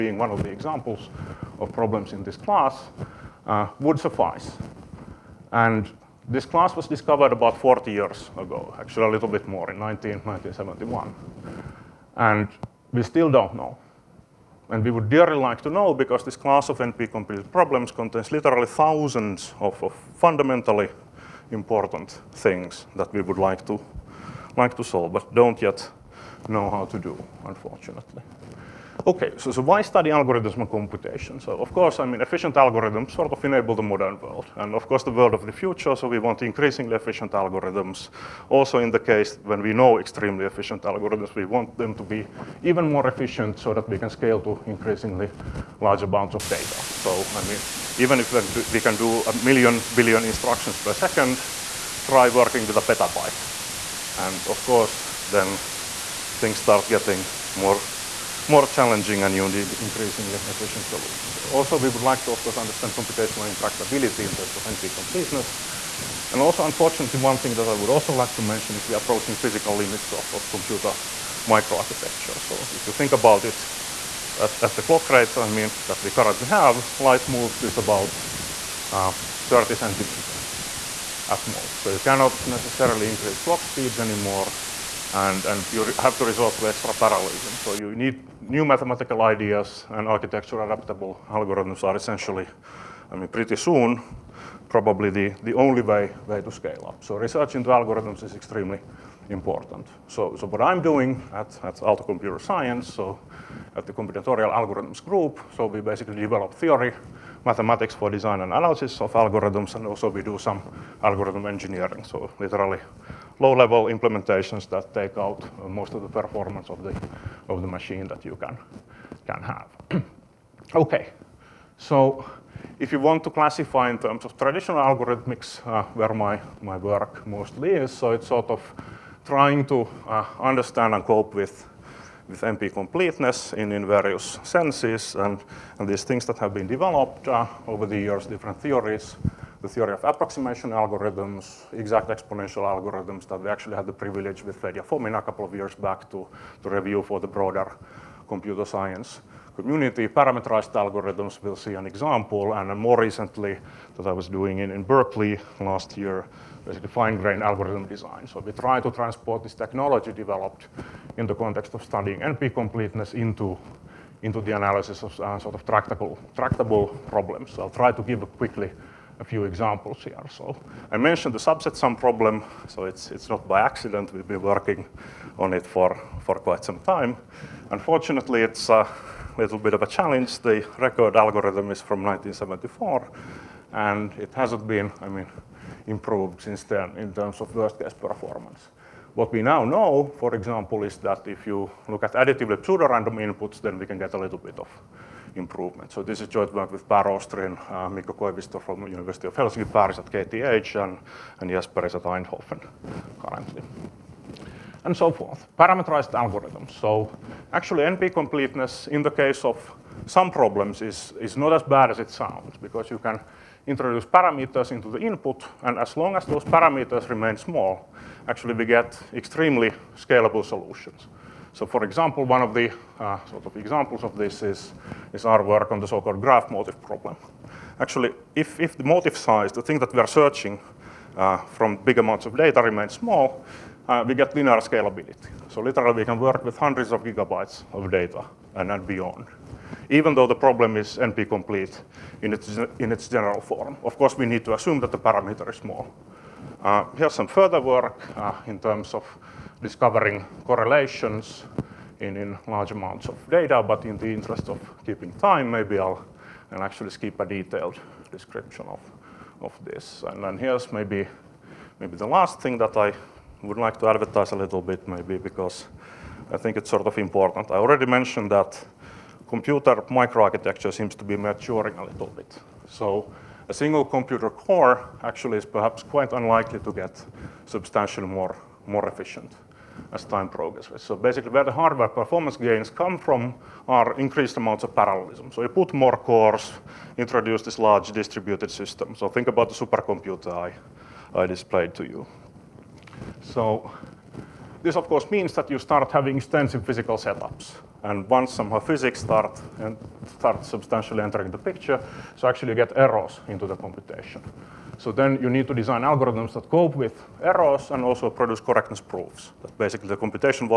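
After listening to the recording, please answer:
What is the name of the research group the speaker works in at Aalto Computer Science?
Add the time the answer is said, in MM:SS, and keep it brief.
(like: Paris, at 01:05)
Combinatorial Algorithms Group, at 01:43.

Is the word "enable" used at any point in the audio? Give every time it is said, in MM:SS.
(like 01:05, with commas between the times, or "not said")
00:33.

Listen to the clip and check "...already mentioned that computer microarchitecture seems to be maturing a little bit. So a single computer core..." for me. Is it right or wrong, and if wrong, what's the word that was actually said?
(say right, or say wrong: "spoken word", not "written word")
right.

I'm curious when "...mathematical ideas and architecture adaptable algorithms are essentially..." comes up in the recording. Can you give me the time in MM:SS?
01:28.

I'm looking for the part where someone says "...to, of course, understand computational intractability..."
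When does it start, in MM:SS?
01:02.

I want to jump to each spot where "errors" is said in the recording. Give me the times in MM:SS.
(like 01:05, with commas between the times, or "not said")
05:02, 05:07.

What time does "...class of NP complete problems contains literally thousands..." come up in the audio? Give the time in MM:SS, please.
00:16.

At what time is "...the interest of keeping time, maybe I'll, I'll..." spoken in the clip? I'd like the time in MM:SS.
04:13.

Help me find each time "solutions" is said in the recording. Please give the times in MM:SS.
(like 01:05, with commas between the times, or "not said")
01:00, 03:40.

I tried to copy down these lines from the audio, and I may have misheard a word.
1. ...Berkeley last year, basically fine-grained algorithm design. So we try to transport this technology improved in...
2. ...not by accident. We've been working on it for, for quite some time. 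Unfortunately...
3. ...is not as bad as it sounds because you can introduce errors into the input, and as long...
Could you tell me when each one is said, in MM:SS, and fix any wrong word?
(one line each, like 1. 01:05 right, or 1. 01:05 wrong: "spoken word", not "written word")
1. 02:34 wrong: "developed", not "improved"
2. 02:53 right
3. 03:31 wrong: "parameters", not "errors".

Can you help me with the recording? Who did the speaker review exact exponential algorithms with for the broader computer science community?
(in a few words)
Fedya Fomin.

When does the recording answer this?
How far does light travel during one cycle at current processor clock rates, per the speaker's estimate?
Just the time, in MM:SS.
01:19.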